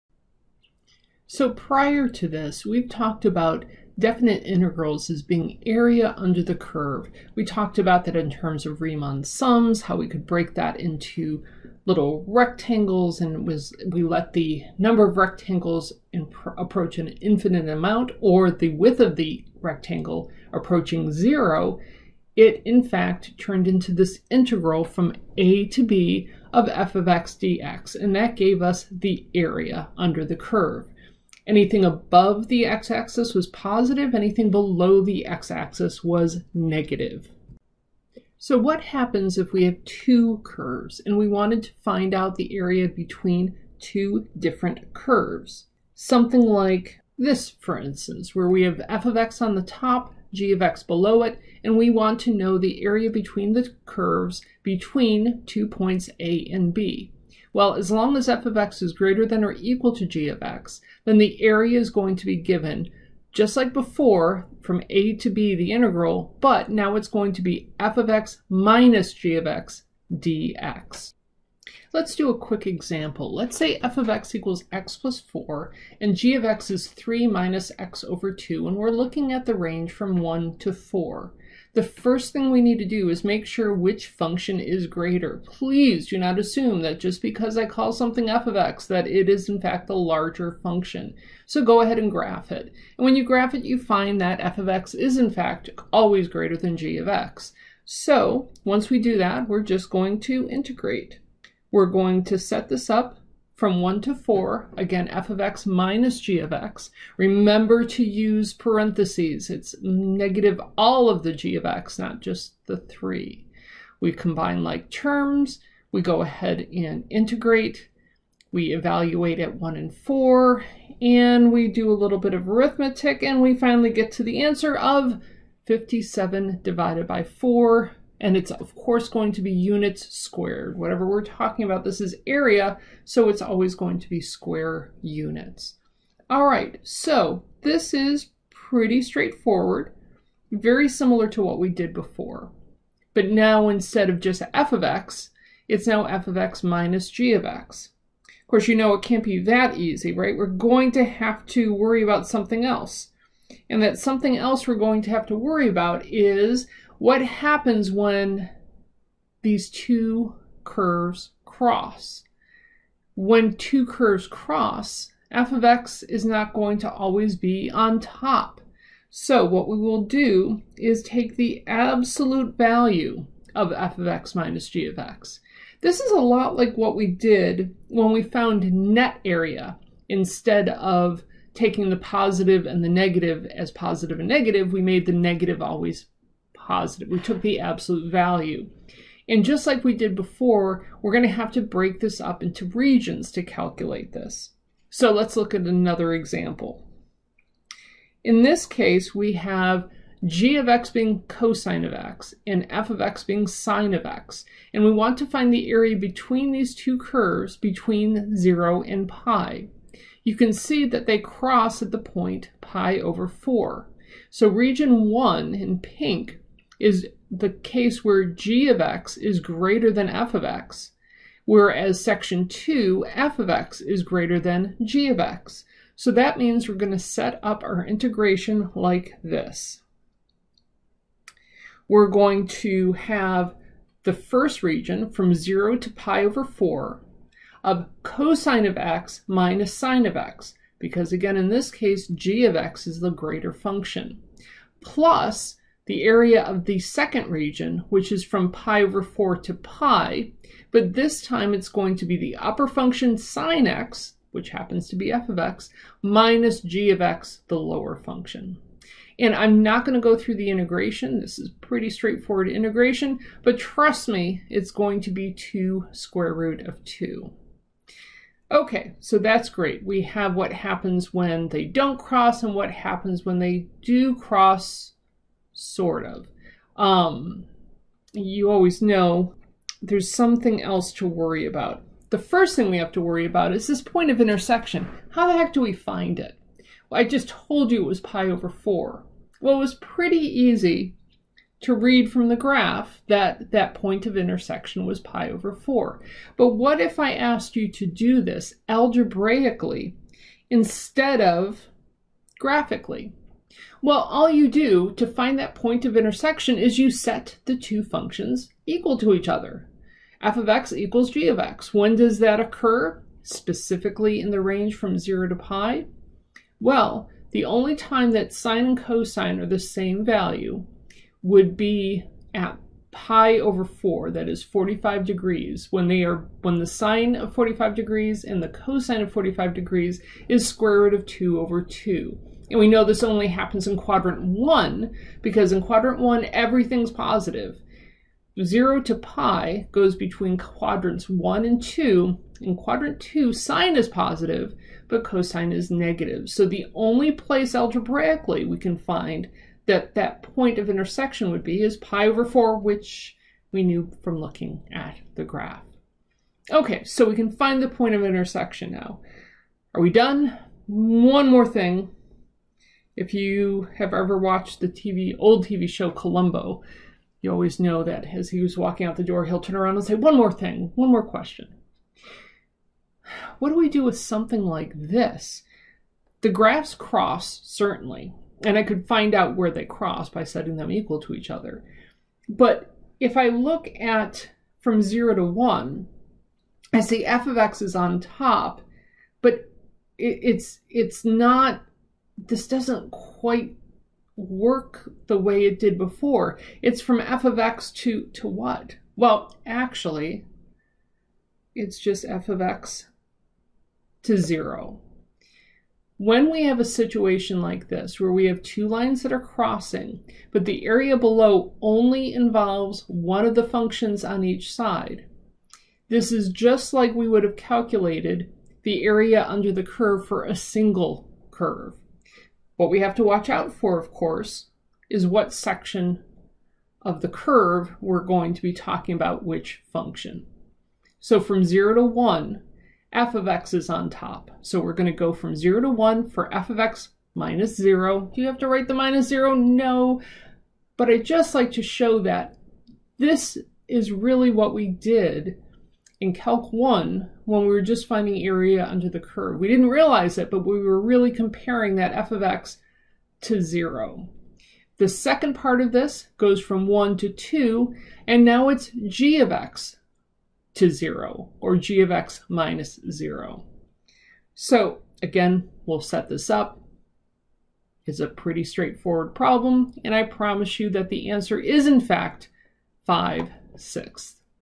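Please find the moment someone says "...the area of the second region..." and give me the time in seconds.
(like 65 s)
245 s.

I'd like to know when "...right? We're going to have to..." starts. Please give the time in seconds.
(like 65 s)
150 s.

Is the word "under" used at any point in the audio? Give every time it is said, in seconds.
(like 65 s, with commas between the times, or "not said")
6 s, 29 s, 419 s, 448 s.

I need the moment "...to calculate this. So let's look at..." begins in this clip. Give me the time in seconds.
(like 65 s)
193 s.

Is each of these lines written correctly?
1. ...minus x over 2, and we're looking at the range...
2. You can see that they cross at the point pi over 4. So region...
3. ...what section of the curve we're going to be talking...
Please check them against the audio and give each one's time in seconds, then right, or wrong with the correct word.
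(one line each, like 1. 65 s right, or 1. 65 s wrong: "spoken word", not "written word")
1. 77 s right
2. 210 s right
3. 425 s right.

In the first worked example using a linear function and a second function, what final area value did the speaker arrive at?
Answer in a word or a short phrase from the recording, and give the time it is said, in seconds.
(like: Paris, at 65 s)
57/4, at 125 s.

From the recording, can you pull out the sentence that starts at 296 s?
But what if I asked you to do this algebraically instead of graphically?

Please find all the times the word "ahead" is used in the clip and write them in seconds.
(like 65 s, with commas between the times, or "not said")
91 s, 116 s.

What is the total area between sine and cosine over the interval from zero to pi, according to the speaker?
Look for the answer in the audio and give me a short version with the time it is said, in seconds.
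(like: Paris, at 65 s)
2 square root of 2, at 265 s.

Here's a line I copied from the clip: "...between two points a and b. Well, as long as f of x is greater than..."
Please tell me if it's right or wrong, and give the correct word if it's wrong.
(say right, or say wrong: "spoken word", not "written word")
right.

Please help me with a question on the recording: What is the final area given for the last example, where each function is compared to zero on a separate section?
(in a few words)
5/6.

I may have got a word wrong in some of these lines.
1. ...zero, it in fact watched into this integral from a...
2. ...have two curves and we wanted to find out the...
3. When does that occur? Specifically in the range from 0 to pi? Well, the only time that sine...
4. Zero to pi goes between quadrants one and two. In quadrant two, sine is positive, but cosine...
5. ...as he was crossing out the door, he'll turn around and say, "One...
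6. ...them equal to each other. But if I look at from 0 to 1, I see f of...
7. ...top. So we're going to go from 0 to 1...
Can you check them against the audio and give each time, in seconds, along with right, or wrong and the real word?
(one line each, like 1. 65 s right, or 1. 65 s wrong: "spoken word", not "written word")
1. 21 s wrong: "turned", not "watched"
2. 39 s right
3. 311 s right
4. 338 s right
5. 368 s wrong: "walking", not "crossing"
6. 380 s right
7. 433 s right.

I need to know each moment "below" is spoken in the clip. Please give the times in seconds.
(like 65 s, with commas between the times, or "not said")
34 s, 50 s, 410 s.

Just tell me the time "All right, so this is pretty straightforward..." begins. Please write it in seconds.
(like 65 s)
136 s.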